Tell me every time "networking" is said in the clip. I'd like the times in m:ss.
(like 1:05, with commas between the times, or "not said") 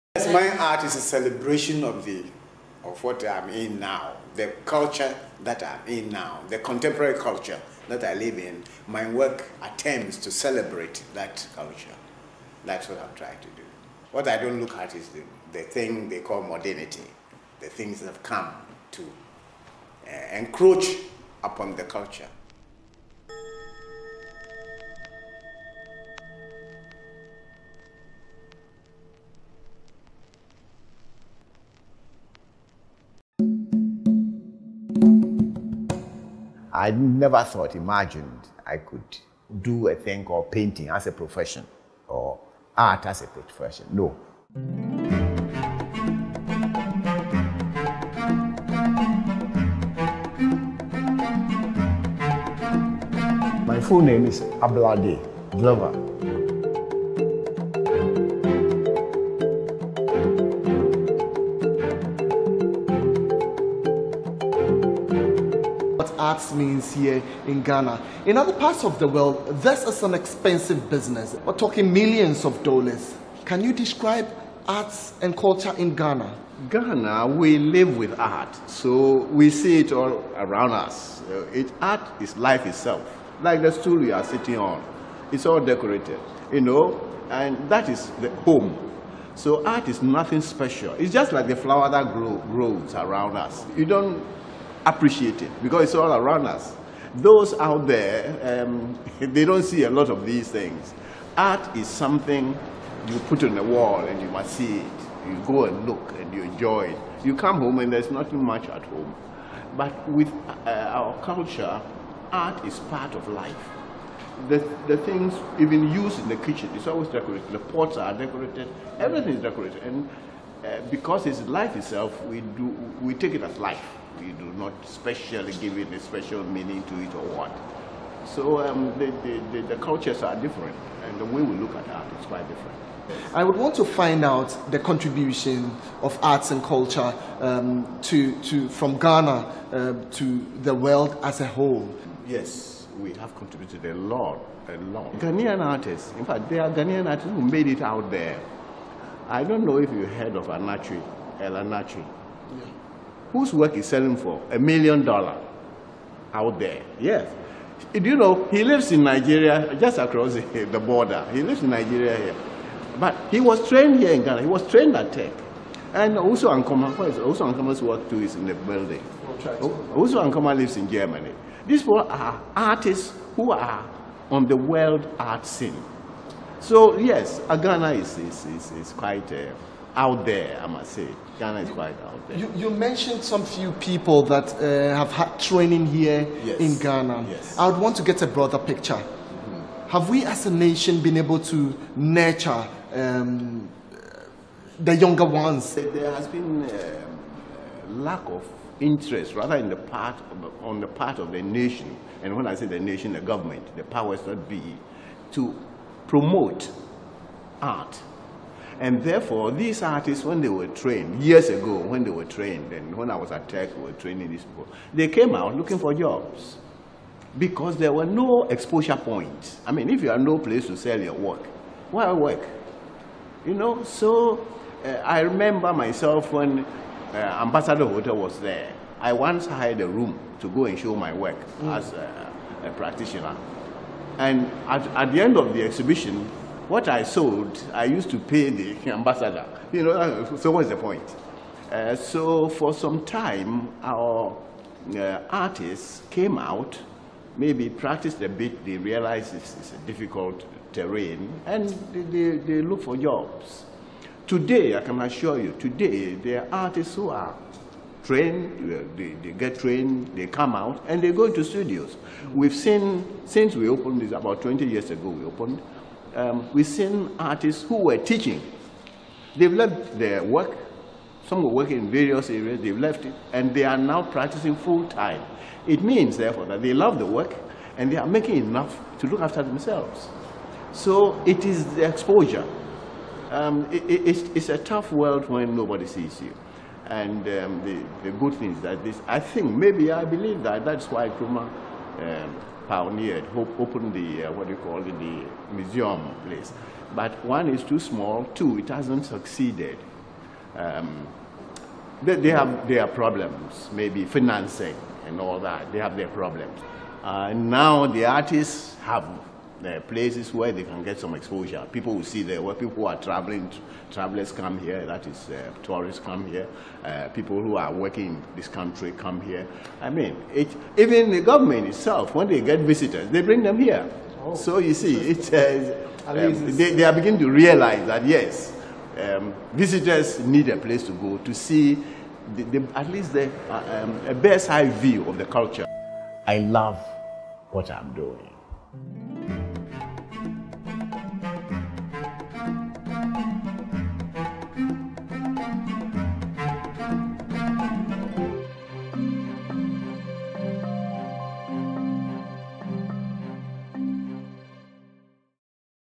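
not said.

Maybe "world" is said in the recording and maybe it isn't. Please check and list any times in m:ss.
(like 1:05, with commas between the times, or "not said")
1:09, 2:20, 2:54, 4:44.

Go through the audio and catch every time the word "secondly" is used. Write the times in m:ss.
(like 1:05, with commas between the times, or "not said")
not said.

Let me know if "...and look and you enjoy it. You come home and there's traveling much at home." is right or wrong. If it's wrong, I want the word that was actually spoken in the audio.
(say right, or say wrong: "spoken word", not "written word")
wrong: "nothing", not "traveling".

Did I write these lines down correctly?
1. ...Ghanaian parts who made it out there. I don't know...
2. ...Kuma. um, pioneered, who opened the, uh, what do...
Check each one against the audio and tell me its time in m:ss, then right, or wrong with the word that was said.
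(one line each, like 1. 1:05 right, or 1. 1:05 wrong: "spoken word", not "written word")
1. 2:26 wrong: "artists", not "parts"
2. 4:51 right.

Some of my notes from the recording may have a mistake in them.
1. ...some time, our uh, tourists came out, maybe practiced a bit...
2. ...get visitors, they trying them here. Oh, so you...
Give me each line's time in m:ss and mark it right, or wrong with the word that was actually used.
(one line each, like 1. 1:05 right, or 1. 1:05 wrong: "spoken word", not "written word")
1. 4:02 wrong: "artists", not "tourists"
2. 5:22 wrong: "bring", not "trying".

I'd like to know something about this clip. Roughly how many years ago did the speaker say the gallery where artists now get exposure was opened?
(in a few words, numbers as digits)
20 years.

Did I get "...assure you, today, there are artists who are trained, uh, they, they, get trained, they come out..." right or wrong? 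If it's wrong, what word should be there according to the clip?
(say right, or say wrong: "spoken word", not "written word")
right.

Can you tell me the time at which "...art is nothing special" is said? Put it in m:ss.
1:29.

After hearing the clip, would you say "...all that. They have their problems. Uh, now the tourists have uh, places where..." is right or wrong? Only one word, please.
wrong.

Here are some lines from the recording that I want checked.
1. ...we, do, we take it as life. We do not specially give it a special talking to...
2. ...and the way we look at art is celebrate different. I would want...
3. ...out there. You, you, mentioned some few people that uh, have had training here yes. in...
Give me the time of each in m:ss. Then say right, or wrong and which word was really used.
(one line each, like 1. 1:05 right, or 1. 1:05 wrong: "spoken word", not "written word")
1. 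2:02 wrong: "meaning", not "talking"
2. 2:11 wrong: "quite", not "celebrate"
3. 3:02 right.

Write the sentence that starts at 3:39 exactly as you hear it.
I mean, if you have no place to sell your work, why work?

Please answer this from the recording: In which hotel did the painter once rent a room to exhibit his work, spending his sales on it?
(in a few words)
Ambassador Hotel.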